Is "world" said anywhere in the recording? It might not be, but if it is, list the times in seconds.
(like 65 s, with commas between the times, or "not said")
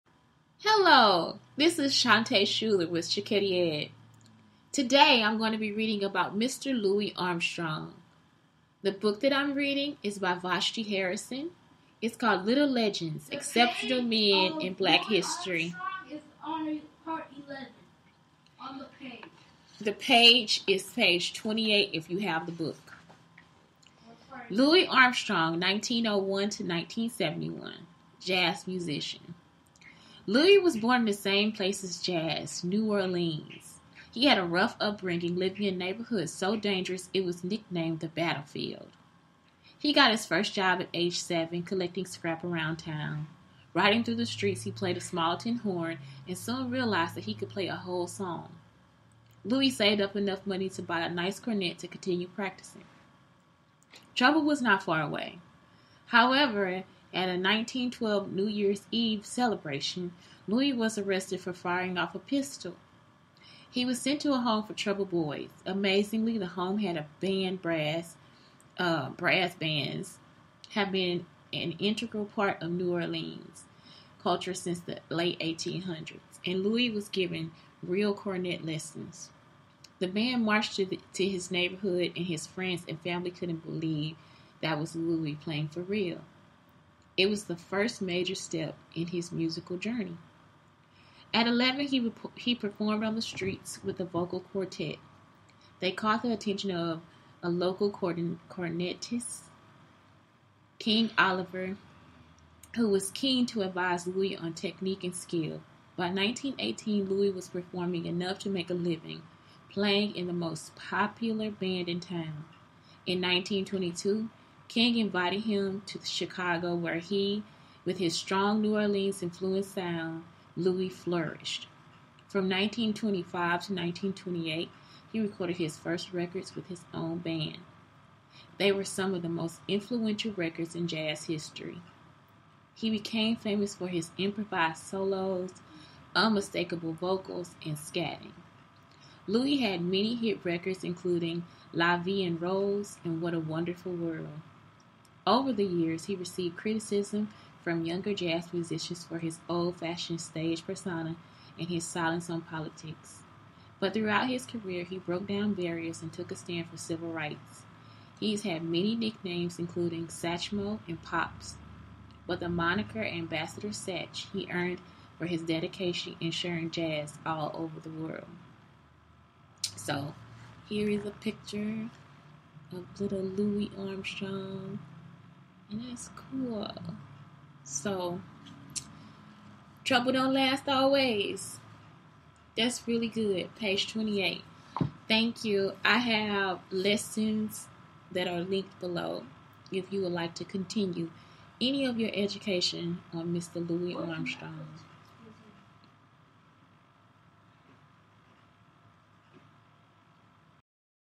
143 s, 167 s.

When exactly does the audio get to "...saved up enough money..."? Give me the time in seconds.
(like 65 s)
49 s.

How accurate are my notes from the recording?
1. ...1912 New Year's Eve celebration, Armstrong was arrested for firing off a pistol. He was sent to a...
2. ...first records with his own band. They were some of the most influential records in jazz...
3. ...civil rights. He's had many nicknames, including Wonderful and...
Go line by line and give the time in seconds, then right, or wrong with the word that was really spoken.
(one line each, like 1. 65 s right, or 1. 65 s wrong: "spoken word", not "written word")
1. 57 s wrong: "Louis", not "Armstrong"
2. 125 s right
3. 156 s wrong: "Satchmo", not "Wonderful".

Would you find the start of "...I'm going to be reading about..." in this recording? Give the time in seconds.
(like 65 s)
5 s.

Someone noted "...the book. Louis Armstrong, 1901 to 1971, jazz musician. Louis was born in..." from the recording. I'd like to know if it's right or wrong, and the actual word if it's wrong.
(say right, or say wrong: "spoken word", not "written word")
right.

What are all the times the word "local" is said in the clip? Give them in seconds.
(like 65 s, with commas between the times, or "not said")
97 s.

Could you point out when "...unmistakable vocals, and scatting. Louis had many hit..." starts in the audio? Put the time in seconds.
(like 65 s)
136 s.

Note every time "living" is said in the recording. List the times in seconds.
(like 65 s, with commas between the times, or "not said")
35 s, 108 s.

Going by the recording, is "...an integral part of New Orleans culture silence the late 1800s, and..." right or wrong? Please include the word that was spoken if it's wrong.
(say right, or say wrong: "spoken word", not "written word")
wrong: "since", not "silence".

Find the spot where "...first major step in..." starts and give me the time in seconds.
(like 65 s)
87 s.